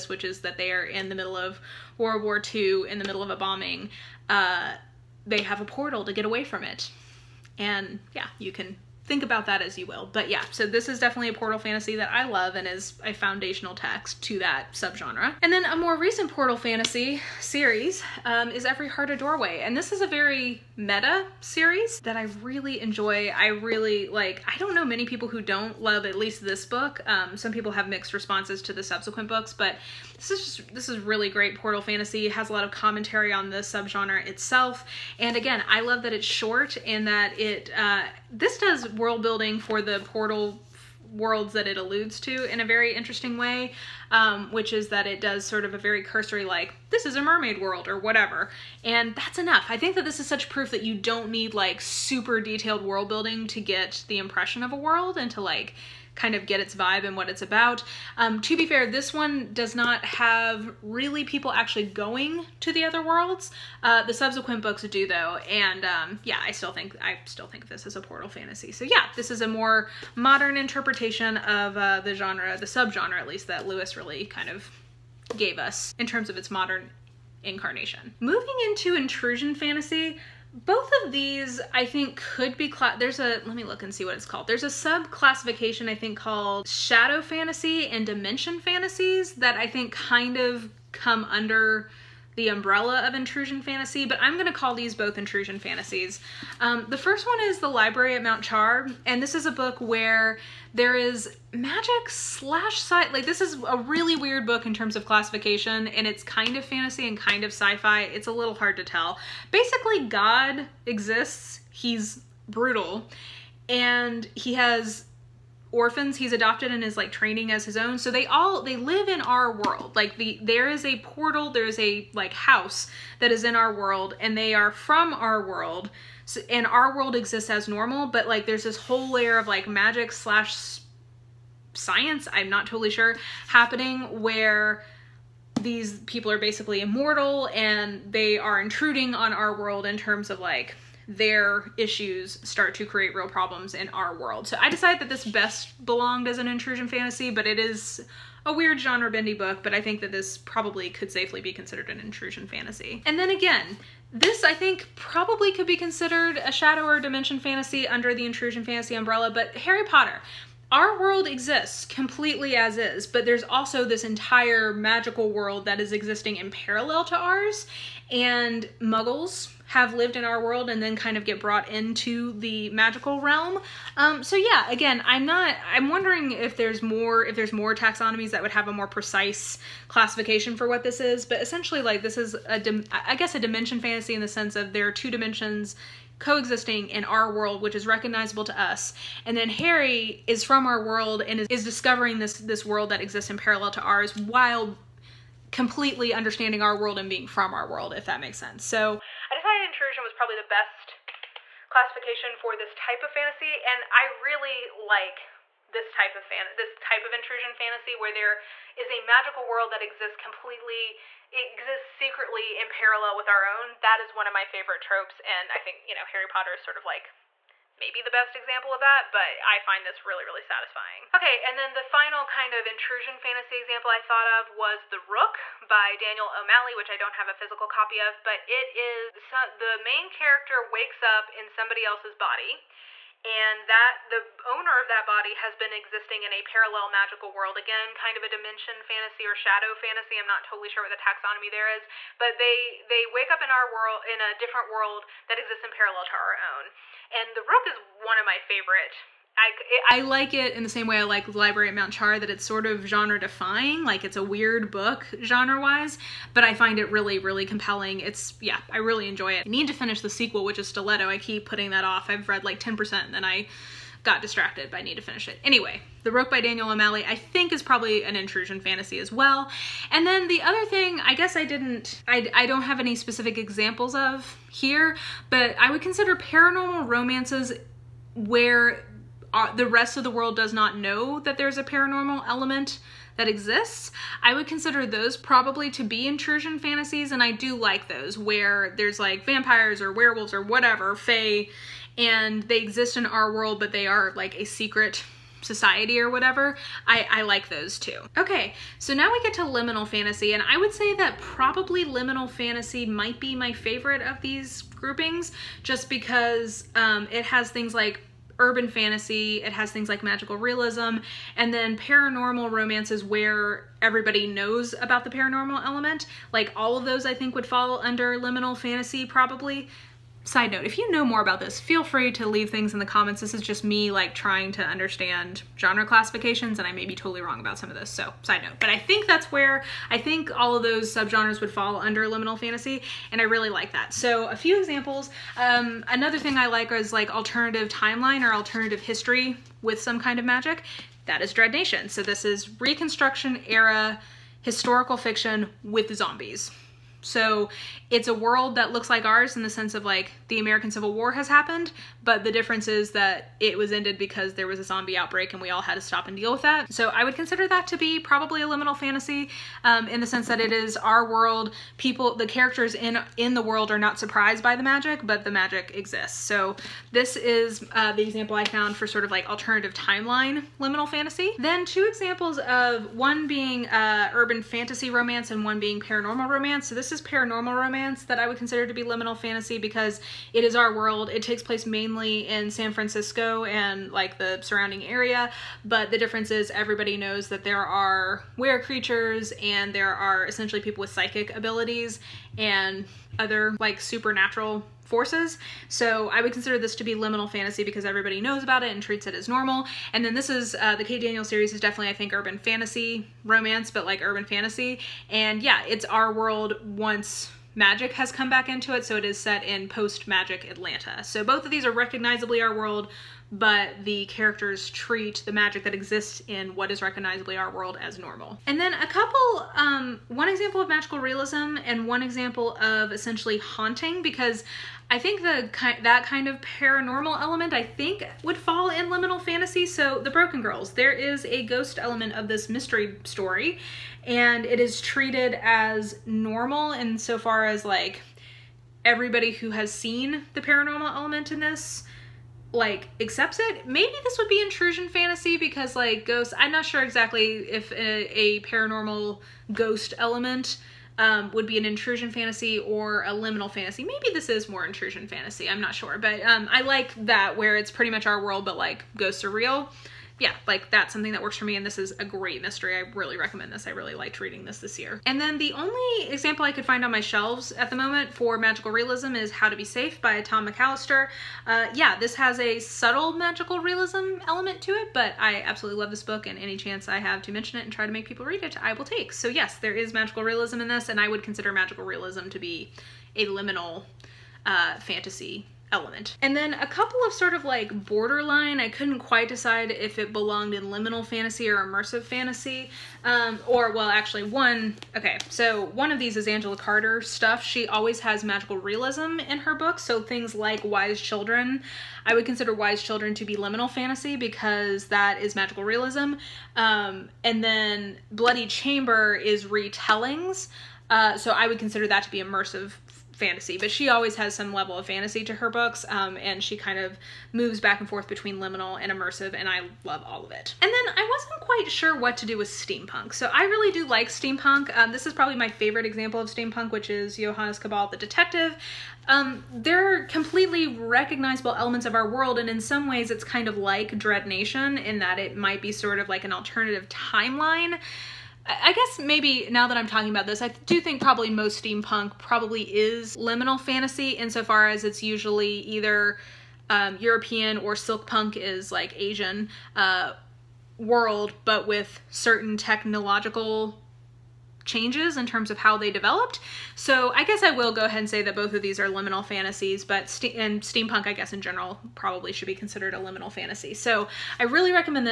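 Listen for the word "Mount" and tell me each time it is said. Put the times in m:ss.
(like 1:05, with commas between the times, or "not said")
1:38, 4:11.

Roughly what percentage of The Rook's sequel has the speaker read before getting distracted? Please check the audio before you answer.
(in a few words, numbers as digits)
10%.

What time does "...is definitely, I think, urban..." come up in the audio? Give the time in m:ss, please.
6:41.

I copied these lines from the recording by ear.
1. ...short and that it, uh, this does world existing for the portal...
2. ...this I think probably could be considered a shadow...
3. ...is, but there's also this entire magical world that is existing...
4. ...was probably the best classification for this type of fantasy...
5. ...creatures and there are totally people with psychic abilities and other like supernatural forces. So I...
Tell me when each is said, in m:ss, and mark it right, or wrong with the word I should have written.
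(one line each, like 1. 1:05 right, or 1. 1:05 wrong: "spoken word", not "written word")
1. 0:36 wrong: "building", not "existing"
2. 2:34 right
3. 2:42 right
4. 3:20 right
5. 6:28 wrong: "essentially", not "totally".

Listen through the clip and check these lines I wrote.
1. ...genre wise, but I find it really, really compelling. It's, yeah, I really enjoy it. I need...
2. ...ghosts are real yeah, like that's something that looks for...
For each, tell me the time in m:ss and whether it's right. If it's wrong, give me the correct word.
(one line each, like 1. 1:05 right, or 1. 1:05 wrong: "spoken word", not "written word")
1. 4:15 right
2. 7:38 wrong: "works", not "looks".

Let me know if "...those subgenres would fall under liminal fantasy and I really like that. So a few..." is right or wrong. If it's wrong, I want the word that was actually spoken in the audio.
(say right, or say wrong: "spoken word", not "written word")
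right.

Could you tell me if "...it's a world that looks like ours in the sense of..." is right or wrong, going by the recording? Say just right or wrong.
right.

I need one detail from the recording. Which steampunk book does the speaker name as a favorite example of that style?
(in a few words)
Johannes Cabal the Detective.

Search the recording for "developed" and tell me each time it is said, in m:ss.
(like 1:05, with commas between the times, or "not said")
9:15.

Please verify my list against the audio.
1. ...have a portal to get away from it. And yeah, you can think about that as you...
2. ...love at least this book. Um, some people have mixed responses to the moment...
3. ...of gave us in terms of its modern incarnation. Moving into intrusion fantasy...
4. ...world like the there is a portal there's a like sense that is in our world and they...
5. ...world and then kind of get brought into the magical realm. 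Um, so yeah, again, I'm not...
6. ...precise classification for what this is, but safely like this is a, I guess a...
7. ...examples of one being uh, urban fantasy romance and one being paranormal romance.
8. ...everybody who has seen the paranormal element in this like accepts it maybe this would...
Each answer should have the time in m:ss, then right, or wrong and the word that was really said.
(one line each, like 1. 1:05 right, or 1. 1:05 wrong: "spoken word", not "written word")
1. 0:05 right
2. 0:25 wrong: "subsequent", not "moment"
3. 1:14 right
4. 1:59 wrong: "house", not "sense"
5. 2:50 right
6. 2:58 wrong: "essentially", not "safely"
7. 6:11 right
8. 7:18 right.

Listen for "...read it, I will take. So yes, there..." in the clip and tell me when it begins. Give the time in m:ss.
7:58.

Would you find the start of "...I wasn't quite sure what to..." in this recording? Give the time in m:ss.
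8:40.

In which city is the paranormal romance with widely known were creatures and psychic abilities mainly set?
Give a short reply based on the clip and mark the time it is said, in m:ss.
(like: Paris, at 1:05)
San Francisco, at 6:22.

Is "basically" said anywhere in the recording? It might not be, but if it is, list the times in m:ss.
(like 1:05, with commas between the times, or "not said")
1:49, 2:16.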